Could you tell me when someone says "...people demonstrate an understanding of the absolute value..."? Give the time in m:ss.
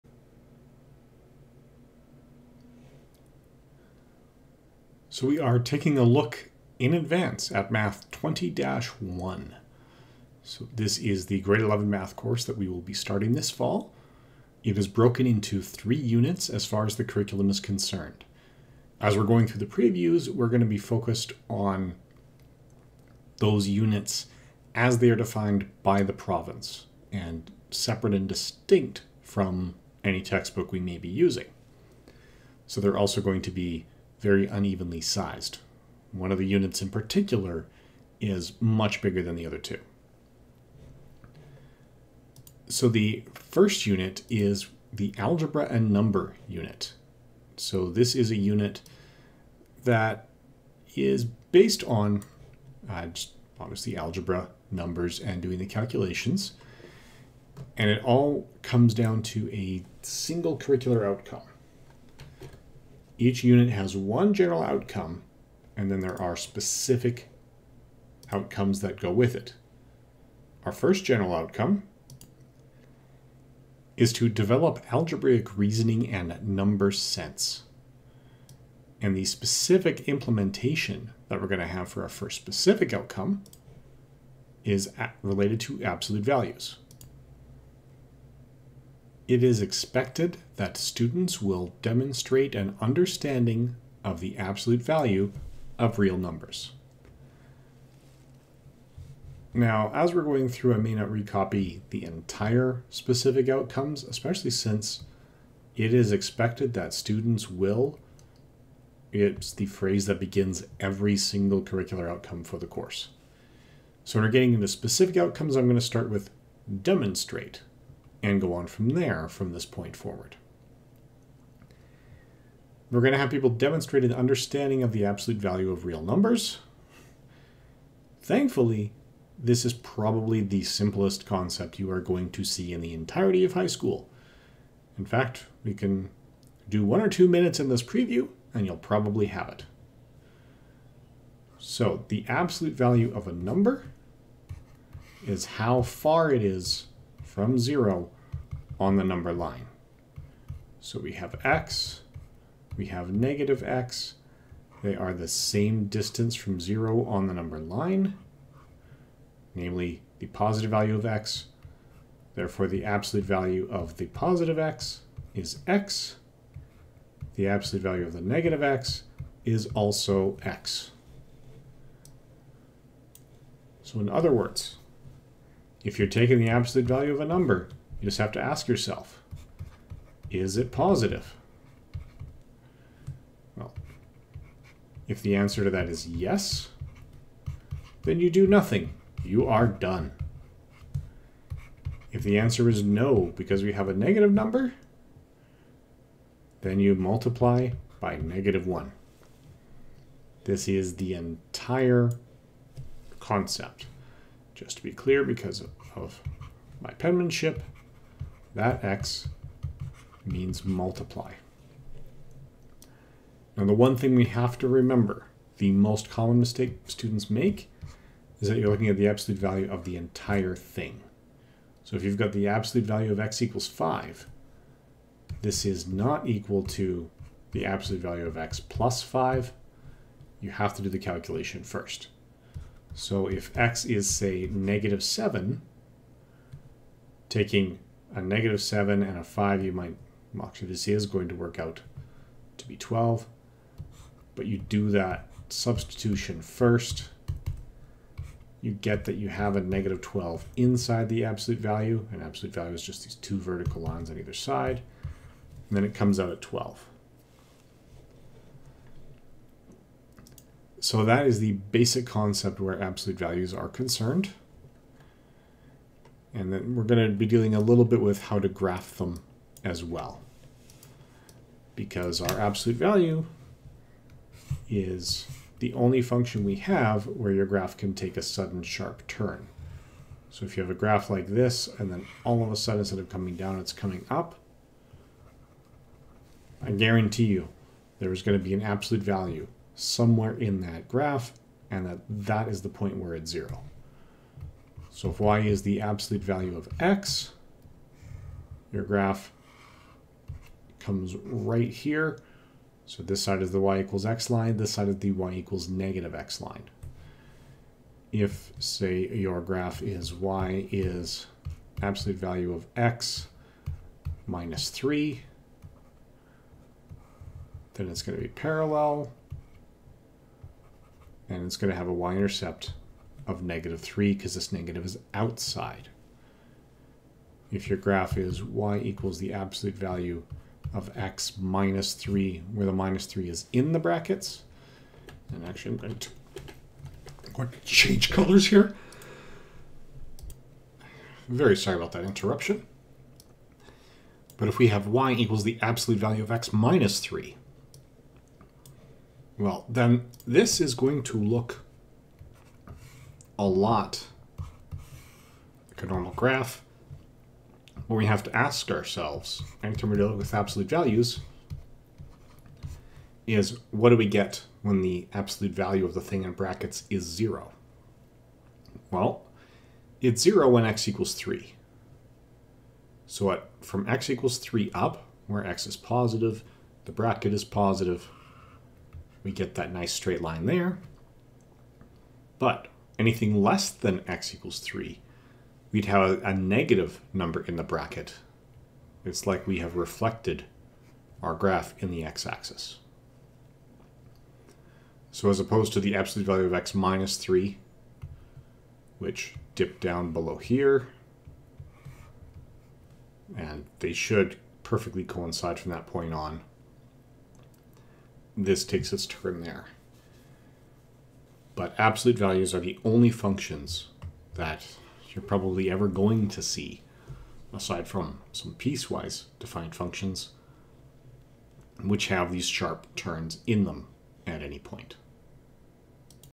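2:03.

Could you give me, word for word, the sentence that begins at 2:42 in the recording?
Therefore, the absolute value of the positive x is x.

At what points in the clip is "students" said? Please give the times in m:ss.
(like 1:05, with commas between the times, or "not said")
1:30, 1:46, 3:36.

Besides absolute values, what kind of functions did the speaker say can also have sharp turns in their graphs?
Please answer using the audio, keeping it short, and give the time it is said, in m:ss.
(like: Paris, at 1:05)
piecewise defined functions, at 6:58.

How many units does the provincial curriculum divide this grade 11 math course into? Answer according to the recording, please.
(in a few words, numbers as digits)
3.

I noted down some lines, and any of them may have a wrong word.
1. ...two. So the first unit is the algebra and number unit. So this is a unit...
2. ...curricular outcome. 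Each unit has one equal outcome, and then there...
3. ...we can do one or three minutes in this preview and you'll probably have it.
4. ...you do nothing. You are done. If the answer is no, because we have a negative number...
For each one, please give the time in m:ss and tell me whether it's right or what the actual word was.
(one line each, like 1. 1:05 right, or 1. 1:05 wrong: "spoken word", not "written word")
1. 0:39 right
2. 1:00 wrong: "general", not "equal"
3. 2:15 wrong: "two", not "three"
4. 3:08 right.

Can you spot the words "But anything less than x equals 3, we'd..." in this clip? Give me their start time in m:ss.
6:22.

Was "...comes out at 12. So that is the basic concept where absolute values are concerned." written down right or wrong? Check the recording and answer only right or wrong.
right.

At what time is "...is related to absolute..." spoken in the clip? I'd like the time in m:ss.
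1:24.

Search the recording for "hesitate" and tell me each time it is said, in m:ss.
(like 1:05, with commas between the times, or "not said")
not said.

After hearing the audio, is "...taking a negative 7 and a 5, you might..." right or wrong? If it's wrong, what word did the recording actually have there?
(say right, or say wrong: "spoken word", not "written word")
right.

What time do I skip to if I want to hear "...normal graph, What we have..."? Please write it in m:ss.
5:55.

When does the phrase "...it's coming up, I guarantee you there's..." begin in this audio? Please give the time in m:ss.
4:43.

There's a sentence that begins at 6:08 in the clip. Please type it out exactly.
Well, it's zero when x equals three.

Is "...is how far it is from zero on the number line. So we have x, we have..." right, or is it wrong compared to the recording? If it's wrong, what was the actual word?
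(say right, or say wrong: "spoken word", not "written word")
right.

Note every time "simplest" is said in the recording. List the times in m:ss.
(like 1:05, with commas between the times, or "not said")
2:10.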